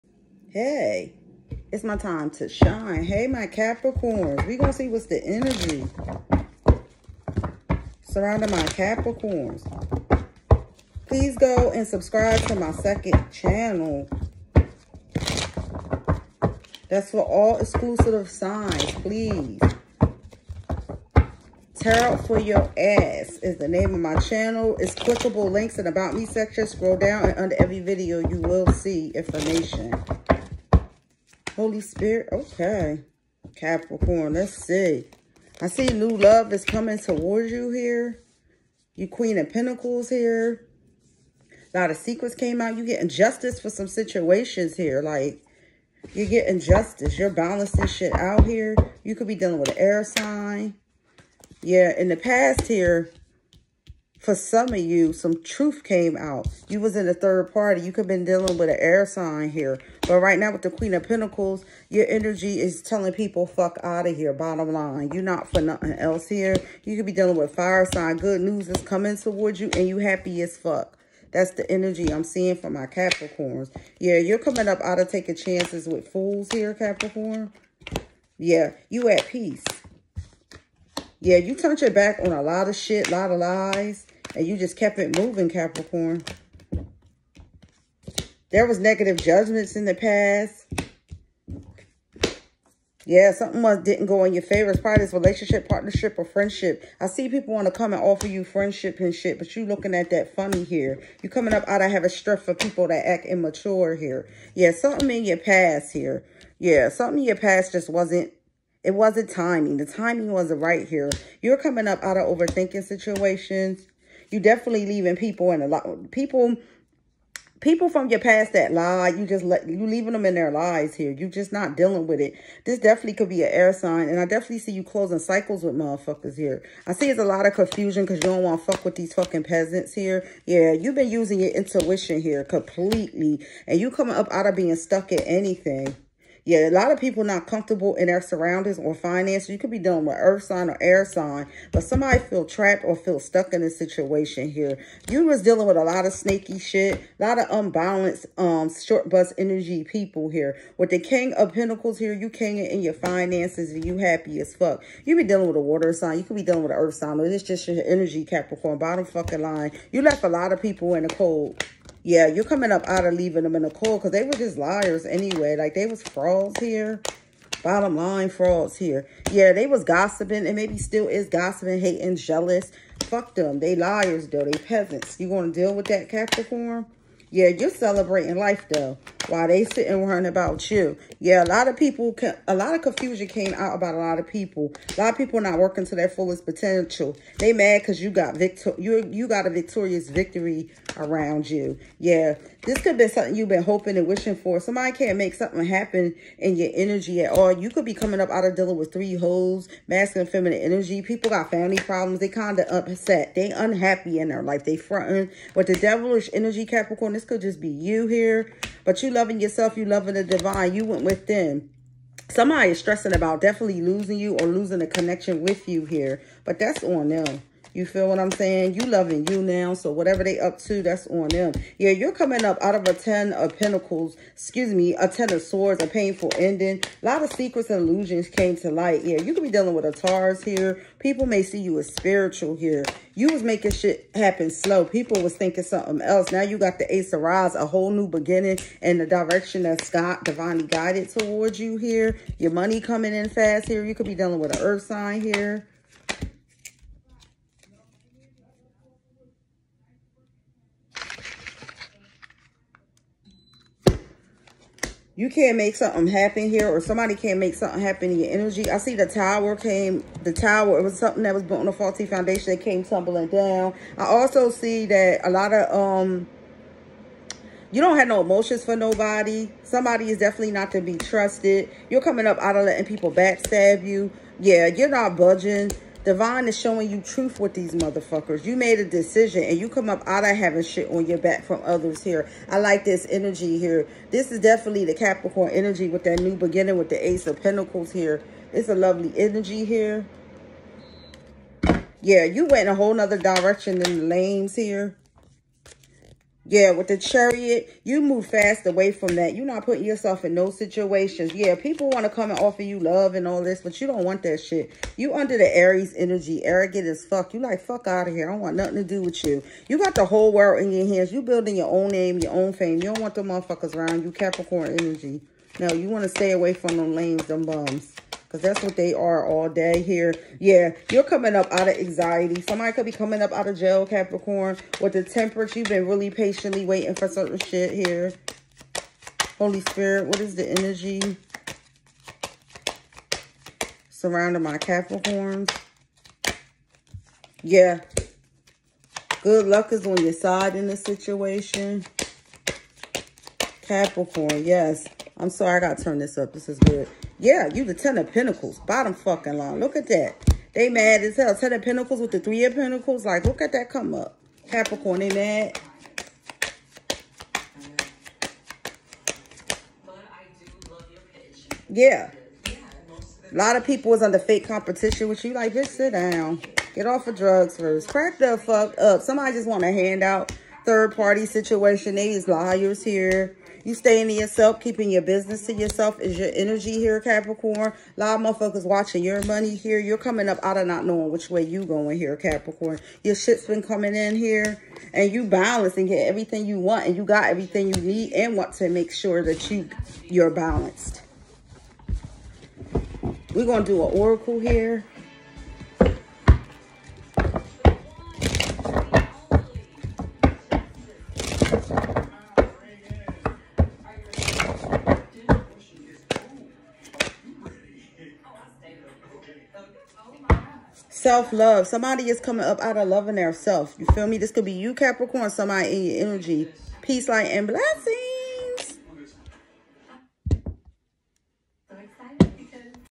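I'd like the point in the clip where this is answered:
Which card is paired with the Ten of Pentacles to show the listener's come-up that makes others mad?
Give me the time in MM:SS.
05:52.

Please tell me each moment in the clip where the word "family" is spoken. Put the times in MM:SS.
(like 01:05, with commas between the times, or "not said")
03:21.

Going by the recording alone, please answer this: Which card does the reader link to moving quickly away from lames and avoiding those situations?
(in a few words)
The Chariot.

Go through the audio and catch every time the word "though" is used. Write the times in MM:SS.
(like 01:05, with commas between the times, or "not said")
02:54, 02:58.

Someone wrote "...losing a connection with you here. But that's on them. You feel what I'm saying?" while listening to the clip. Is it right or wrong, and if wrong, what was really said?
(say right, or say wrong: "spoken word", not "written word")
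right.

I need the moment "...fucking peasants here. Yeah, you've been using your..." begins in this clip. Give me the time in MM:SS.
02:09.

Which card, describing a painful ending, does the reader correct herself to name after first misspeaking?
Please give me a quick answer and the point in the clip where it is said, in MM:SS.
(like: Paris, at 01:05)
10 of Swords, at 03:45.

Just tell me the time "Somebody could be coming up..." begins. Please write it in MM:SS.
05:22.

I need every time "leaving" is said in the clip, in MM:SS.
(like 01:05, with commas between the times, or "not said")
01:54, 01:59, 02:43.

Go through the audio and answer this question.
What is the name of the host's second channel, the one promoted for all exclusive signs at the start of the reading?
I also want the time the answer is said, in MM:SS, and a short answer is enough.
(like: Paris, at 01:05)
Tarot for your ass, at 00:21.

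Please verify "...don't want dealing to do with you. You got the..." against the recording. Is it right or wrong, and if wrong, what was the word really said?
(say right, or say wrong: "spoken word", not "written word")
wrong: "nothing", not "dealing".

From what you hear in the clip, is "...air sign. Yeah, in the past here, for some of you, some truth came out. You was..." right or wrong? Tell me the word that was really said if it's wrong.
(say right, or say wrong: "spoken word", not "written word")
right.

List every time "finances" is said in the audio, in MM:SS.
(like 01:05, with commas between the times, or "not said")
02:18, 02:32.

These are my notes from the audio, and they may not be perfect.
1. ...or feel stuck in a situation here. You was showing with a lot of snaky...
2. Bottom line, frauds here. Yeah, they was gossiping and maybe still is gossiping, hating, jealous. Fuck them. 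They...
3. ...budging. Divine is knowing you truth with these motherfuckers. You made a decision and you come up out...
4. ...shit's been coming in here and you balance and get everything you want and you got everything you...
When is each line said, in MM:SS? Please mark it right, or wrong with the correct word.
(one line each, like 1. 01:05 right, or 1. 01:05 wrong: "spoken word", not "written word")
1. 02:22 wrong: "dealing", not "showing"
2. 02:47 right
3. 04:35 wrong: "showing", not "knowing"
4. 06:23 right.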